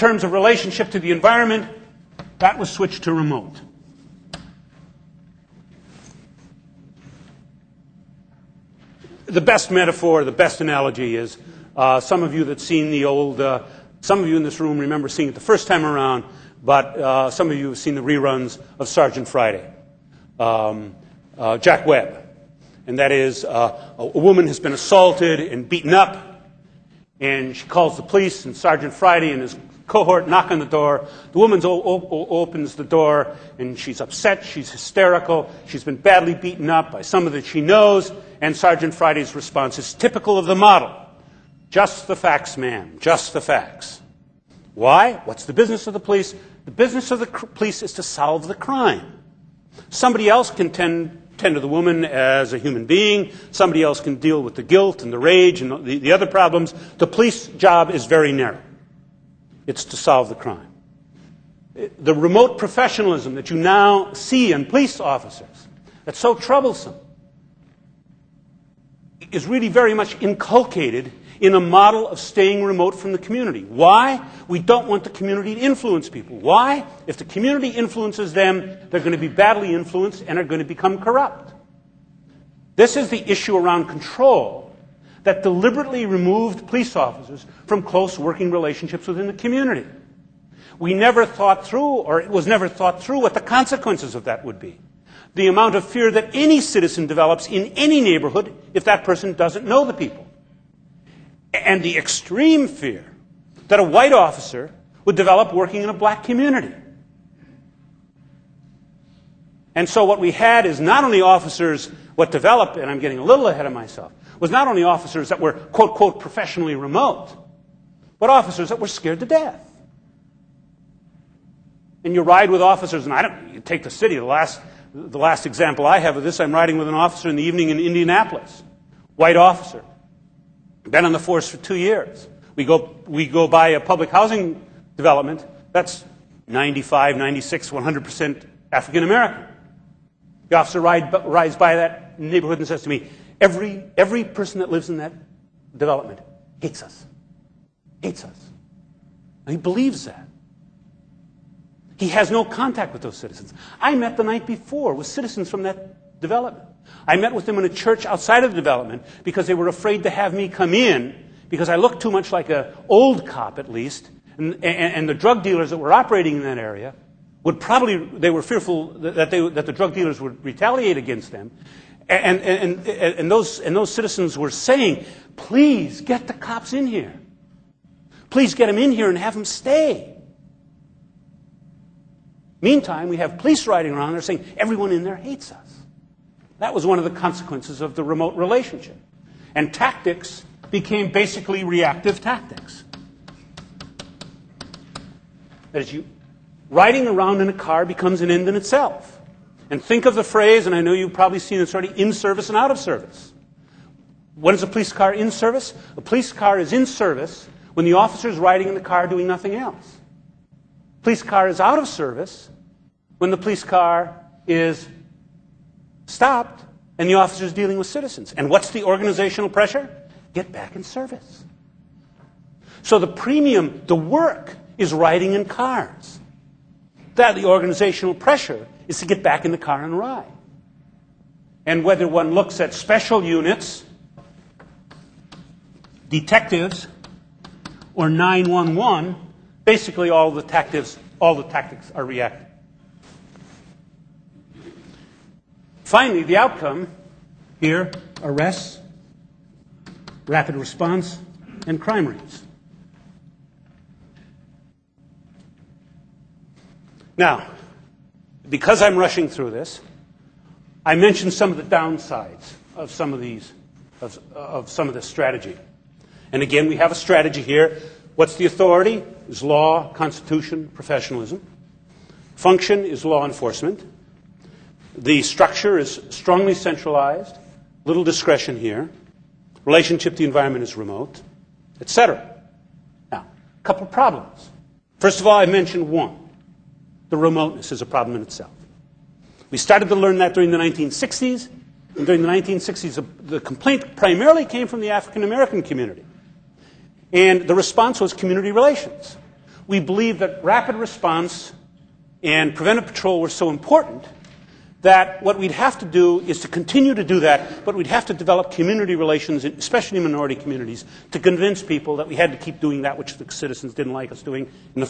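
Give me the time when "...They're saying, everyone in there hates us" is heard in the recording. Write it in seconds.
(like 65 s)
184 s.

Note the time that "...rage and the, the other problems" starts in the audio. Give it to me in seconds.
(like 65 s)
55 s.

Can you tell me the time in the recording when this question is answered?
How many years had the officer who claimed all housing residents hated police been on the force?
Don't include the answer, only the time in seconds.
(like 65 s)
131 s.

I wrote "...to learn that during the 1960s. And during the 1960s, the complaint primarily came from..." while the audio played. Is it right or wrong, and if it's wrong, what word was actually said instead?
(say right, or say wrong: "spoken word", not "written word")
right.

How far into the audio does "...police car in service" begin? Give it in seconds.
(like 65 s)
204 s.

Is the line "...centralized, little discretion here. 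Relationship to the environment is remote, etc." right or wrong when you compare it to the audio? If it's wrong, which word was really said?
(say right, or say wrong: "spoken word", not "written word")
right.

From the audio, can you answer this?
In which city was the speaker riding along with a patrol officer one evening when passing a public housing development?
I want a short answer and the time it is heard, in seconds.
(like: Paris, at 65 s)
Indianapolis, at 127 s.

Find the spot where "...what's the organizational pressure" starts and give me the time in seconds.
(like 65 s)
218 s.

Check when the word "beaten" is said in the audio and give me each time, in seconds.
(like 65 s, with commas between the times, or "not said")
25 s, 36 s.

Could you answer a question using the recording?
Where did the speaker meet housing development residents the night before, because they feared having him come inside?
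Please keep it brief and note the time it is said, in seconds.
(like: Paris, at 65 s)
a church, at 157 s.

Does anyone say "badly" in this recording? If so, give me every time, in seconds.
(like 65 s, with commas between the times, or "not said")
35 s, 79 s.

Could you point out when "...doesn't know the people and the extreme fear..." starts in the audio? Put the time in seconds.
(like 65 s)
99 s.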